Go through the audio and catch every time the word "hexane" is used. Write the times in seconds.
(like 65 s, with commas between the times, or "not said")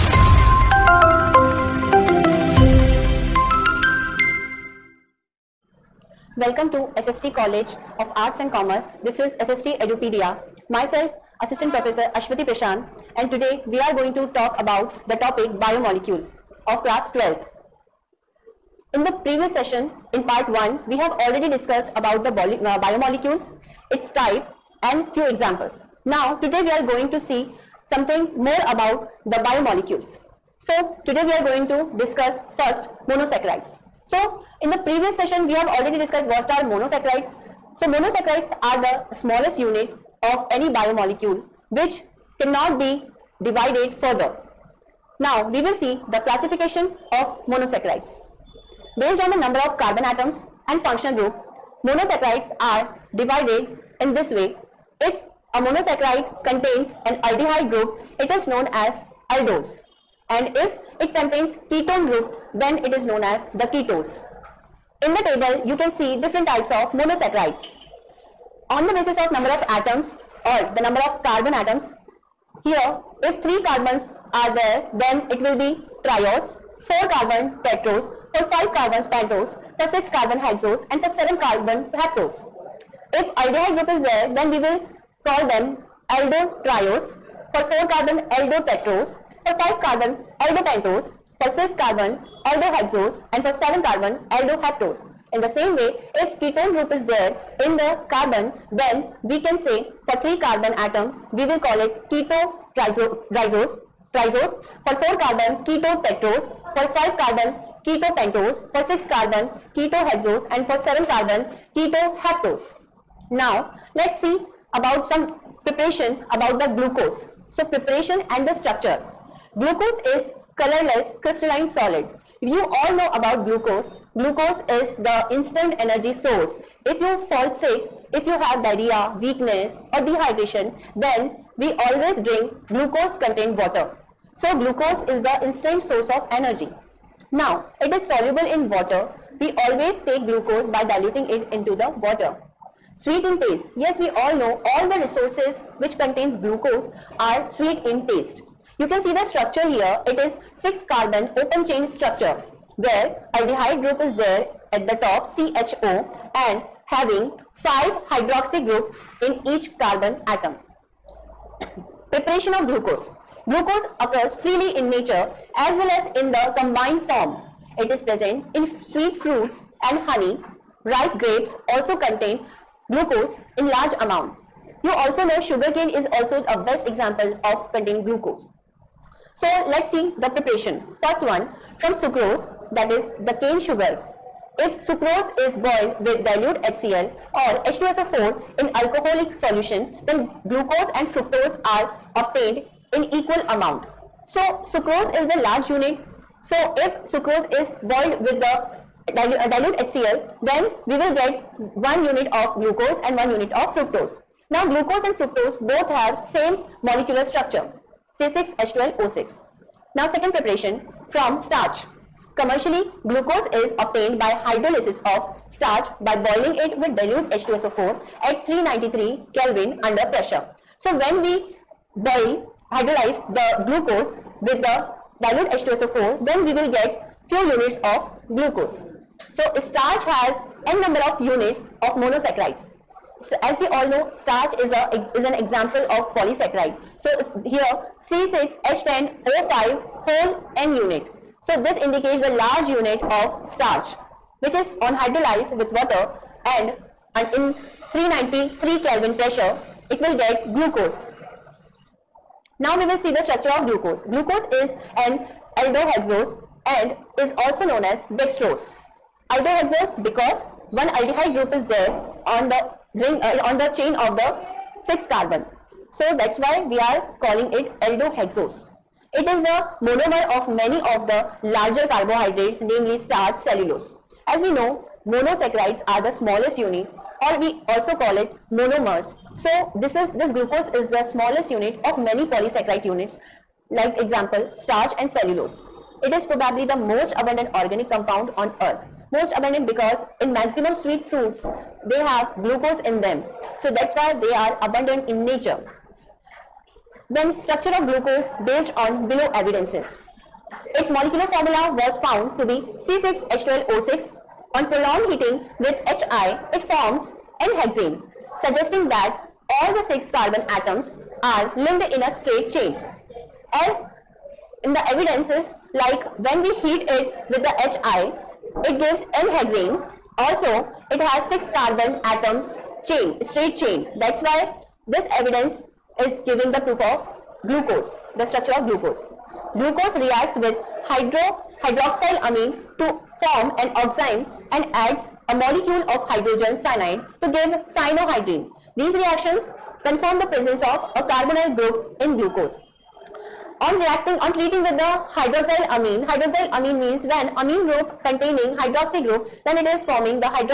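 307 s, 319 s.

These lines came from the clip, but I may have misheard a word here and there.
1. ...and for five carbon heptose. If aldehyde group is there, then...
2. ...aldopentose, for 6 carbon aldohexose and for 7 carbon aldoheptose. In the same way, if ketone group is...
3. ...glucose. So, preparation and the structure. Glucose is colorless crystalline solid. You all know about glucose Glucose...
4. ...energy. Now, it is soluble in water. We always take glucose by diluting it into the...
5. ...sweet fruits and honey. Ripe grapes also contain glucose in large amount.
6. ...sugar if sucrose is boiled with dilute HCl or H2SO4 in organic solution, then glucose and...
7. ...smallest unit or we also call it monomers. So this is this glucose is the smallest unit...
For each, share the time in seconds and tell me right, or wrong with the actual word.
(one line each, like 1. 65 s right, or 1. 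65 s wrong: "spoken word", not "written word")
1. 80 s wrong: "seven", not "five"
2. 90 s right
3. 116 s right
4. 136 s right
5. 168 s right
6. 183 s wrong: "alcoholic", not "organic"
7. 276 s right.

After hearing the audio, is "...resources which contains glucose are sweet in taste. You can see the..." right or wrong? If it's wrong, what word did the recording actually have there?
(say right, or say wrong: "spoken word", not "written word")
right.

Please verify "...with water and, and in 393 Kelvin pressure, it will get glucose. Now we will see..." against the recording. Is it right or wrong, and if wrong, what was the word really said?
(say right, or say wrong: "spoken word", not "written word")
right.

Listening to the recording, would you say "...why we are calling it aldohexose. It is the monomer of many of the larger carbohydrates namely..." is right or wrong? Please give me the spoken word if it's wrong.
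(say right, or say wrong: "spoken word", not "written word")
right.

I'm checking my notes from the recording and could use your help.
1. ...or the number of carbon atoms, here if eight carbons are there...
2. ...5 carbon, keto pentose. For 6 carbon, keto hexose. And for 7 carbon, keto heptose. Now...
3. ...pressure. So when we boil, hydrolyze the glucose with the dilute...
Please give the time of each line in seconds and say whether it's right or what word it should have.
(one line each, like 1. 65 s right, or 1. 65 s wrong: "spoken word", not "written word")
1. 70 s wrong: "three", not "eight"
2. 106 s right
3. 220 s right.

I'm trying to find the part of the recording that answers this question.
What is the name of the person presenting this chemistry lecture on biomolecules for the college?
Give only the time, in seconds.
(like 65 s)
12 s.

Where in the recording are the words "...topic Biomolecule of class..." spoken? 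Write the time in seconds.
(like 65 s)
15 s.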